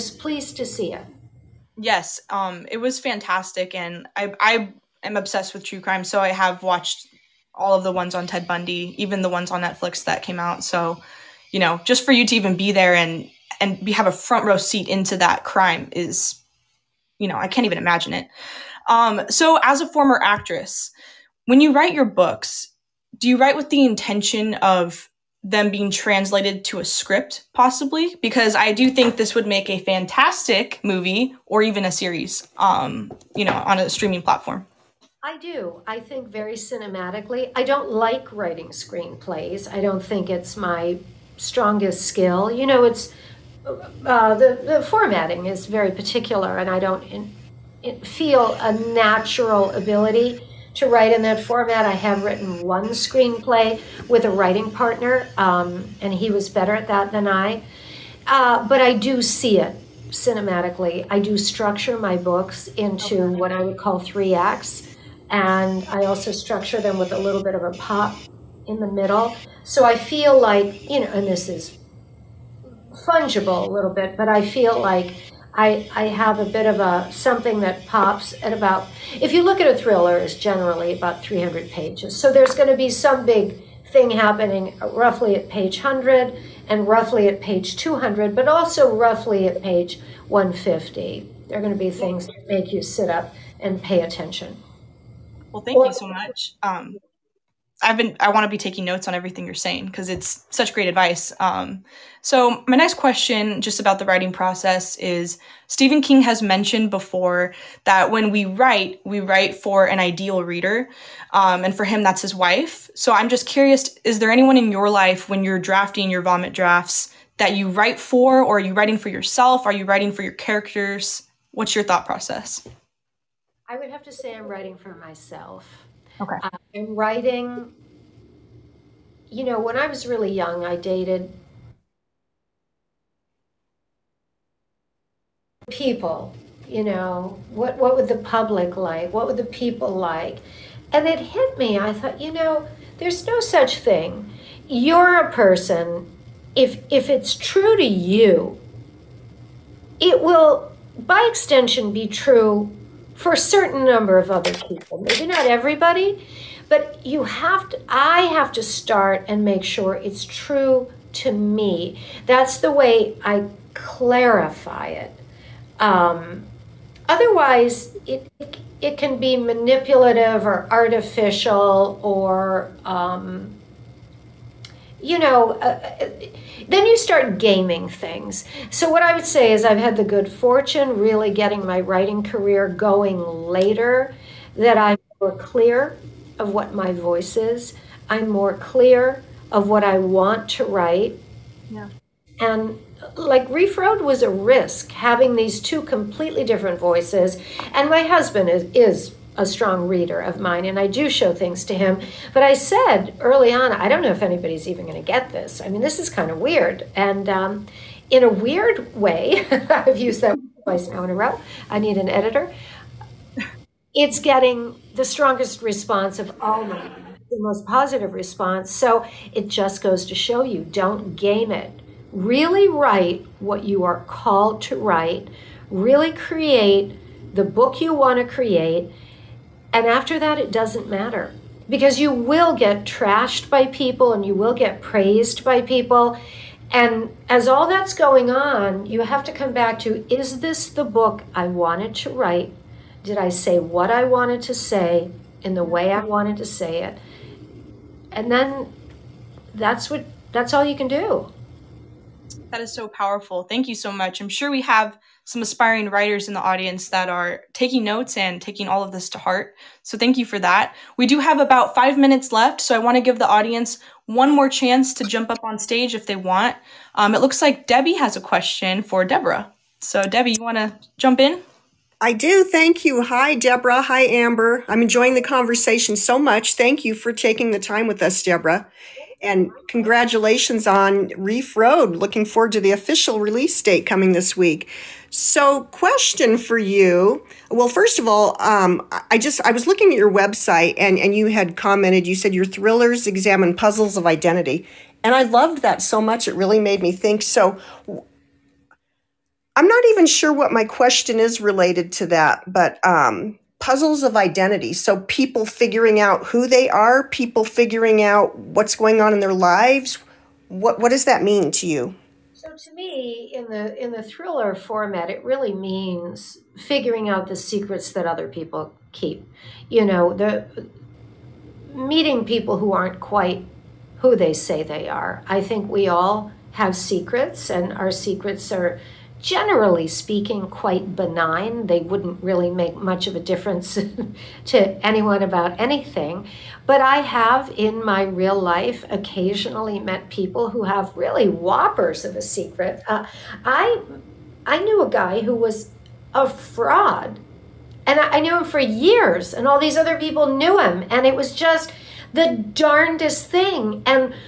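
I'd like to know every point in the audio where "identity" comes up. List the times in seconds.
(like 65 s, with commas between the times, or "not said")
294 s, 304 s.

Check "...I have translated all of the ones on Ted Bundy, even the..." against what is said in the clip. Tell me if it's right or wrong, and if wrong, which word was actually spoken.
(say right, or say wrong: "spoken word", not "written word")
wrong: "watched", not "translated".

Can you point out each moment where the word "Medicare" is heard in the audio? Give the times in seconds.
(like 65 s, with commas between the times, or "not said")
not said.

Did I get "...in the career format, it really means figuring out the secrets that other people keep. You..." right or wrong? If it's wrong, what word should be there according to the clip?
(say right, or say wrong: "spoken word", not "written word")
wrong: "thriller", not "career".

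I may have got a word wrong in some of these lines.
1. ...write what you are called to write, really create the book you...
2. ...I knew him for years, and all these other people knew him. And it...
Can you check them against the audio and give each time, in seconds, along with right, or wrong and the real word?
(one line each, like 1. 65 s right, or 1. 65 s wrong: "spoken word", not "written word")
1. 222 s right
2. 348 s right.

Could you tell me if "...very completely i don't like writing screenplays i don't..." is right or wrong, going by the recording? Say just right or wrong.
wrong.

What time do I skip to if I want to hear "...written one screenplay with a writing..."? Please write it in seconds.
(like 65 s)
52 s.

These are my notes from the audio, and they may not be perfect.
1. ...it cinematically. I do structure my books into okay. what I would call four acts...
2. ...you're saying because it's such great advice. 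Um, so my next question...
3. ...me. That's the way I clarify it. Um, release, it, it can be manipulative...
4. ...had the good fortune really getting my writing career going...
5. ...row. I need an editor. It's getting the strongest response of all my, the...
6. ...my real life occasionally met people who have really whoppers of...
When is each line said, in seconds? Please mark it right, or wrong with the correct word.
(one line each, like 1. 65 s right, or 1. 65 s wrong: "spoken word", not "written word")
1. 59 s wrong: "three", not "four"
2. 99 s right
3. 161 s wrong: "otherwise", not "release"
4. 179 s right
5. 211 s right
6. 337 s right.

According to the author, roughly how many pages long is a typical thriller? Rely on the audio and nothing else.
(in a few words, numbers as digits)
300.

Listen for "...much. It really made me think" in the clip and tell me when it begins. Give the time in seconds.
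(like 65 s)
296 s.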